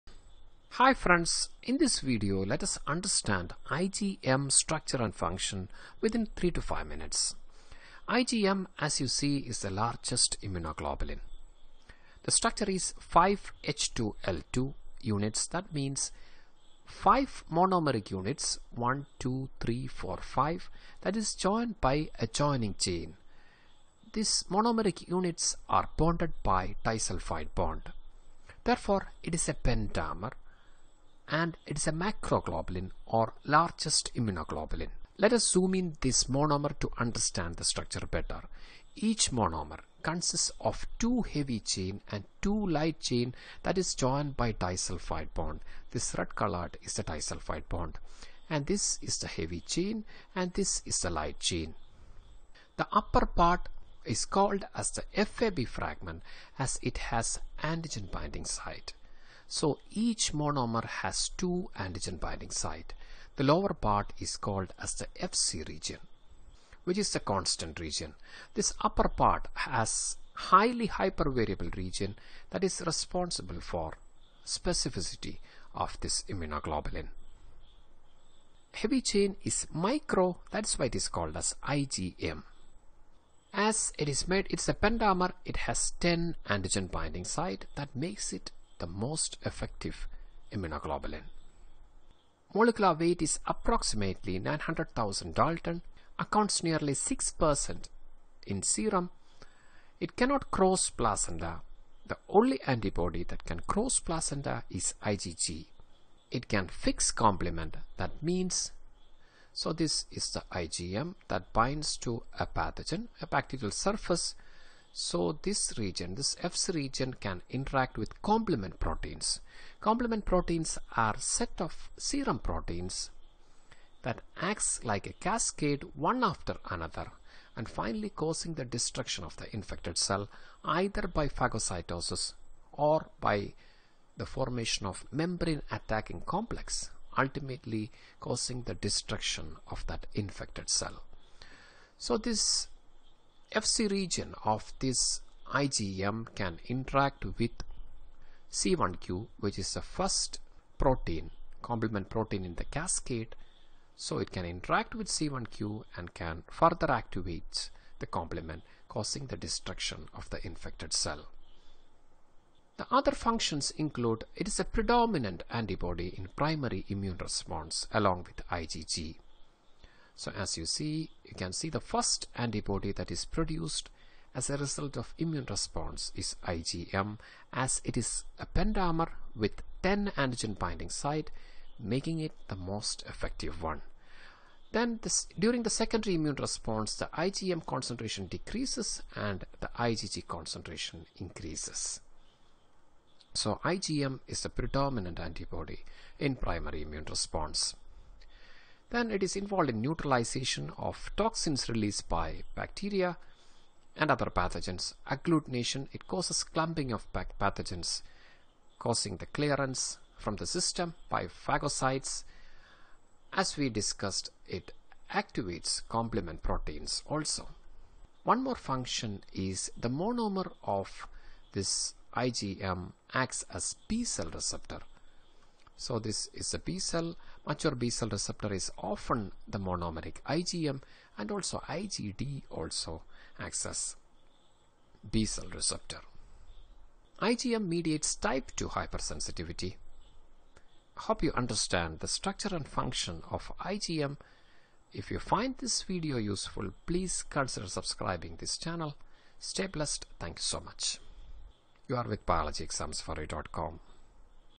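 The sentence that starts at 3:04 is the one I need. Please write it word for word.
Then this, during the secondary immune response the IgM concentration decreases and the IgG concentration increases.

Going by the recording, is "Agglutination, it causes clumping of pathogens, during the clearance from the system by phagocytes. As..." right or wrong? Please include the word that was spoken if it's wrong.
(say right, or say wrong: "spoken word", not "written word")
wrong: "causing", not "during".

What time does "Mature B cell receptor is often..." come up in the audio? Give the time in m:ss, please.
3:47.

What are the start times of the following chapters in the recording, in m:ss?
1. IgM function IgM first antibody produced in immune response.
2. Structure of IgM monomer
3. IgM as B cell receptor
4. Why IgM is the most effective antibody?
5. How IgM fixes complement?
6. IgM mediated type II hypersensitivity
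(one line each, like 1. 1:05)
1. 2:42
2. 0:35
3. 3:38
4. 1:22
5. 1:45
6. 3:58.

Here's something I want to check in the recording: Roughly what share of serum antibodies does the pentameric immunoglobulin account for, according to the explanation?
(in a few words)
6%.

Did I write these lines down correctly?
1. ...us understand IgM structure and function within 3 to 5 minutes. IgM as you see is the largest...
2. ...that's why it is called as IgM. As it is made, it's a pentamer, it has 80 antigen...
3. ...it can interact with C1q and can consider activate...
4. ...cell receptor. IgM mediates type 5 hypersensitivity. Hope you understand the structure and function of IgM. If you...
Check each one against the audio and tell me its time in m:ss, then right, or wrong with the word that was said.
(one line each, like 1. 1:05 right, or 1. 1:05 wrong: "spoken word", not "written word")
1. 0:02 right
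2. 1:20 wrong: "10", not "80"
3. 2:34 wrong: "further", not "consider"
4. 3:55 wrong: "2", not "5".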